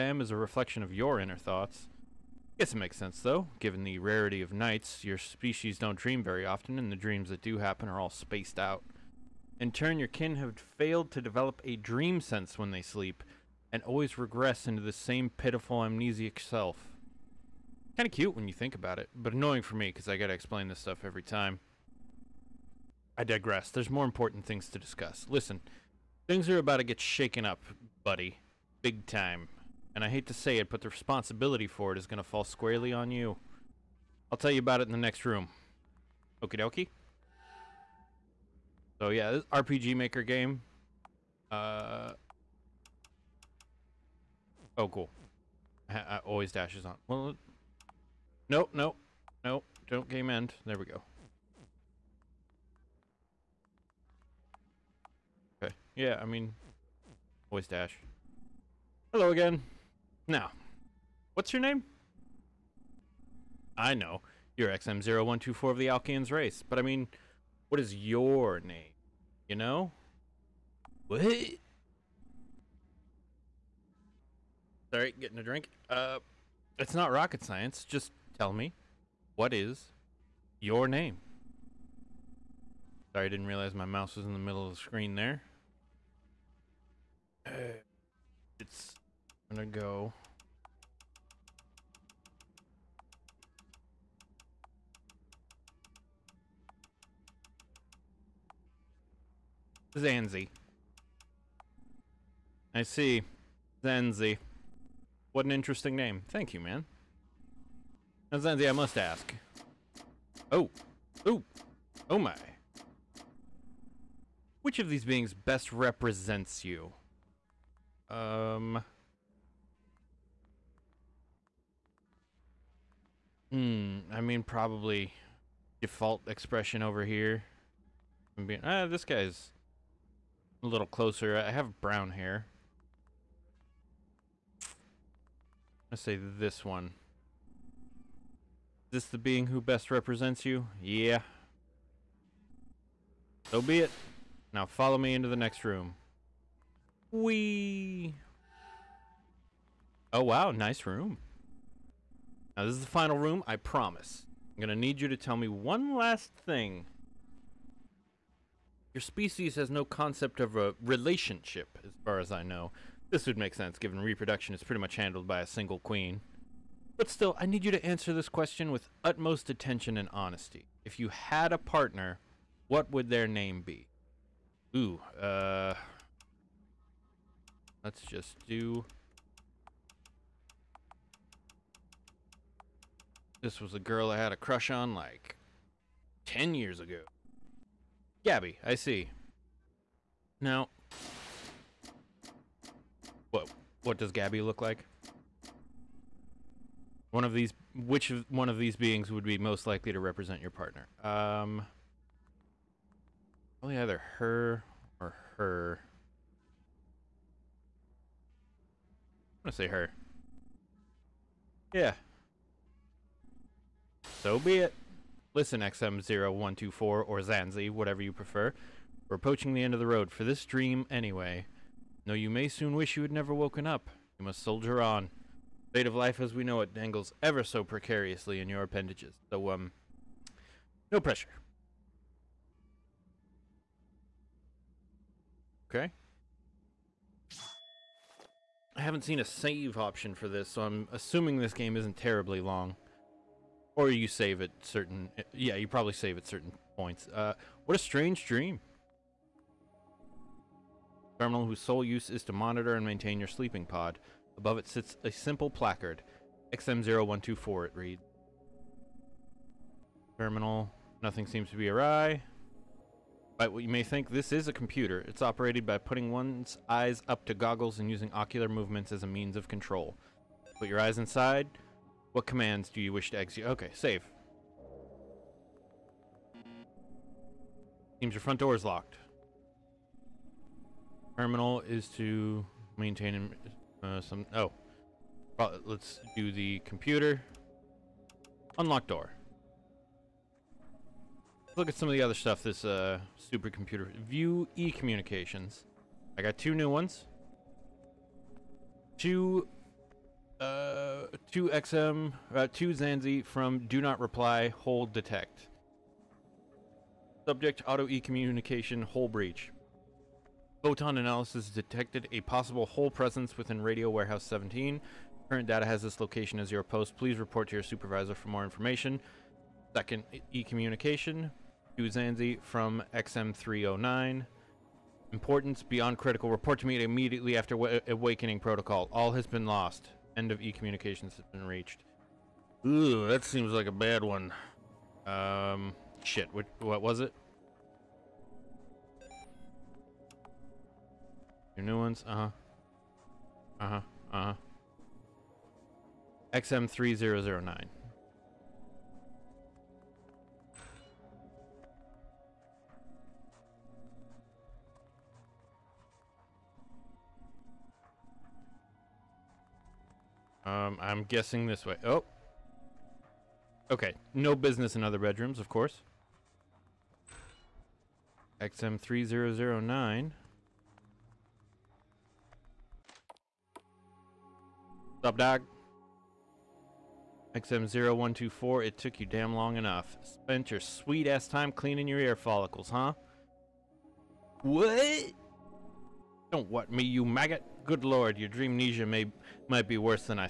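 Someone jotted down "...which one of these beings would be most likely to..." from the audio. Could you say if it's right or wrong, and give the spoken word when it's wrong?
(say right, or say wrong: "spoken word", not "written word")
right.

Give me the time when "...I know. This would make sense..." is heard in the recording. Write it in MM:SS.
02:42.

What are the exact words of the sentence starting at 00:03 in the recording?
Given the rarity of nights, your species don't dream very often, and the dreams that do happen are all spaced out.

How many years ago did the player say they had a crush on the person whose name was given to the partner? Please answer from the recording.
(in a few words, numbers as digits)
10.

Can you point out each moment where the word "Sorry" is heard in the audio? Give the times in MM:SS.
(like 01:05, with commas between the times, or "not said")
01:14, 01:23.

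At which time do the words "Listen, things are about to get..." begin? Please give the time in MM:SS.
00:25.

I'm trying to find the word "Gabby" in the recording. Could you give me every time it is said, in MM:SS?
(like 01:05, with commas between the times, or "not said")
03:08, 03:14.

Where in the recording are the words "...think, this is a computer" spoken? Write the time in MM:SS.
04:23.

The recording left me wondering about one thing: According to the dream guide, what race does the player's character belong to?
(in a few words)
Alkians.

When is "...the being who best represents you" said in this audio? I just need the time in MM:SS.
02:19.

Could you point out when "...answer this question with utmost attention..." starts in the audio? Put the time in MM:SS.
02:47.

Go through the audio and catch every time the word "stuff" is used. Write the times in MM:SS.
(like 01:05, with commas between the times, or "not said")
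00:20, 04:52.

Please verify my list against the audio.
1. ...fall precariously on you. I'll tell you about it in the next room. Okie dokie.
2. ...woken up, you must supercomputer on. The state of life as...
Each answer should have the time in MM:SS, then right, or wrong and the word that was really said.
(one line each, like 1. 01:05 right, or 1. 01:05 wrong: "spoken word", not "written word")
1. 00:32 wrong: "squarely", not "precariously"
2. 03:43 wrong: "soldier", not "supercomputer".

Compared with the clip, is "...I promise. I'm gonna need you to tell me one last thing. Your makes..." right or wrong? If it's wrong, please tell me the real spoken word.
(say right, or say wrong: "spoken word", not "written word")
wrong: "species", not "makes".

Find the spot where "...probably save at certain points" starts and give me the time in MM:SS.
04:05.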